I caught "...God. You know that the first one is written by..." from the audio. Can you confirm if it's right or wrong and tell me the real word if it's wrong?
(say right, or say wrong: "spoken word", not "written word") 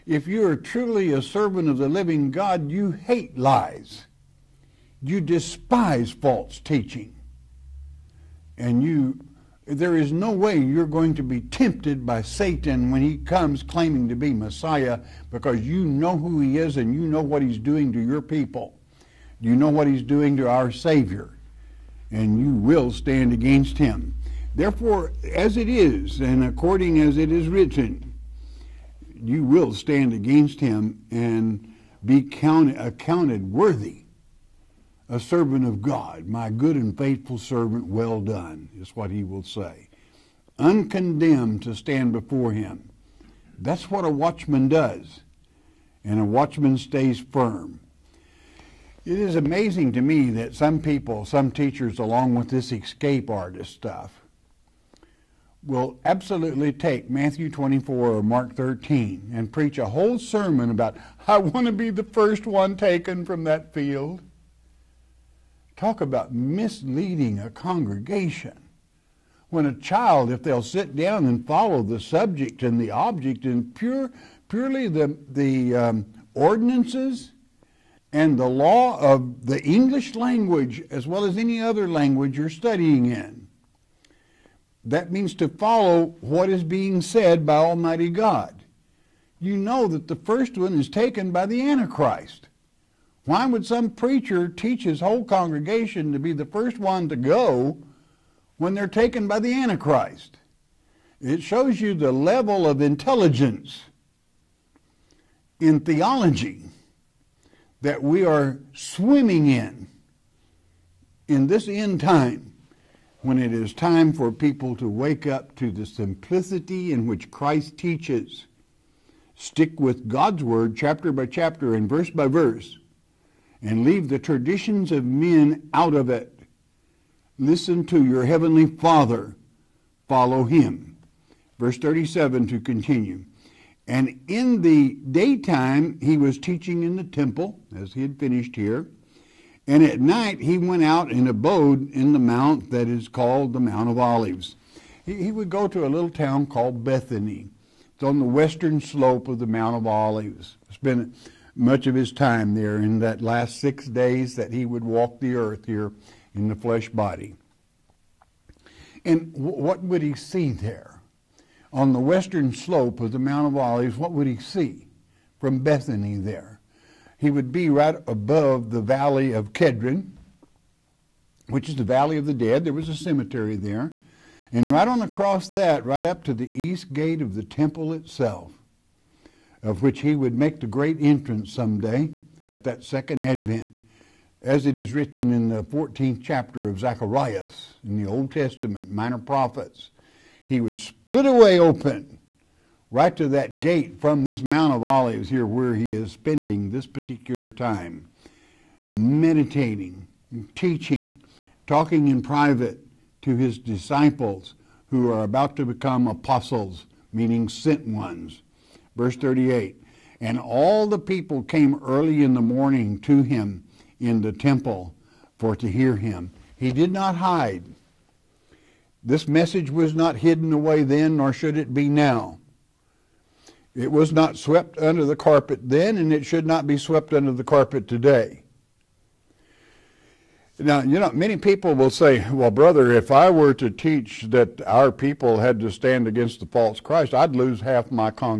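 wrong: "taken", not "written".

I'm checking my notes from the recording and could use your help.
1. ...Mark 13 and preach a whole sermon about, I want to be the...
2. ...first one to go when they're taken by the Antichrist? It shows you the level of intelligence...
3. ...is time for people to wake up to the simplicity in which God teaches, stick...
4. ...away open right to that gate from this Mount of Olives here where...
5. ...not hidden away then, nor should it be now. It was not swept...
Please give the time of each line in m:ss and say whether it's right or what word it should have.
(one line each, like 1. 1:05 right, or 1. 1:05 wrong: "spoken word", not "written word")
1. 0:58 right
2. 1:36 right
3. 1:53 wrong: "Christ", not "God"
4. 3:11 right
5. 3:39 right.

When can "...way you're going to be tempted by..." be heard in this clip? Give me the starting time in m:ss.
0:10.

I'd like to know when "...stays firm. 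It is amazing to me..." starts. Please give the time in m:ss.
0:46.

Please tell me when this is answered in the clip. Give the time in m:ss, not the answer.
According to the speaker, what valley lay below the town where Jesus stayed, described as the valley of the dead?
2:48.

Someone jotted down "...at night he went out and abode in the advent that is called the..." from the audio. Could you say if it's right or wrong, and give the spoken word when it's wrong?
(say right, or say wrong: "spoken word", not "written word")
wrong: "mount", not "advent".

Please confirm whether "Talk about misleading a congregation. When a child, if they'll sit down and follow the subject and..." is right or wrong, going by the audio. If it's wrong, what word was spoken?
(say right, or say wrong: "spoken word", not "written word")
right.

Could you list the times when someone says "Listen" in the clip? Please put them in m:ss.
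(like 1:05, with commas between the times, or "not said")
2:07.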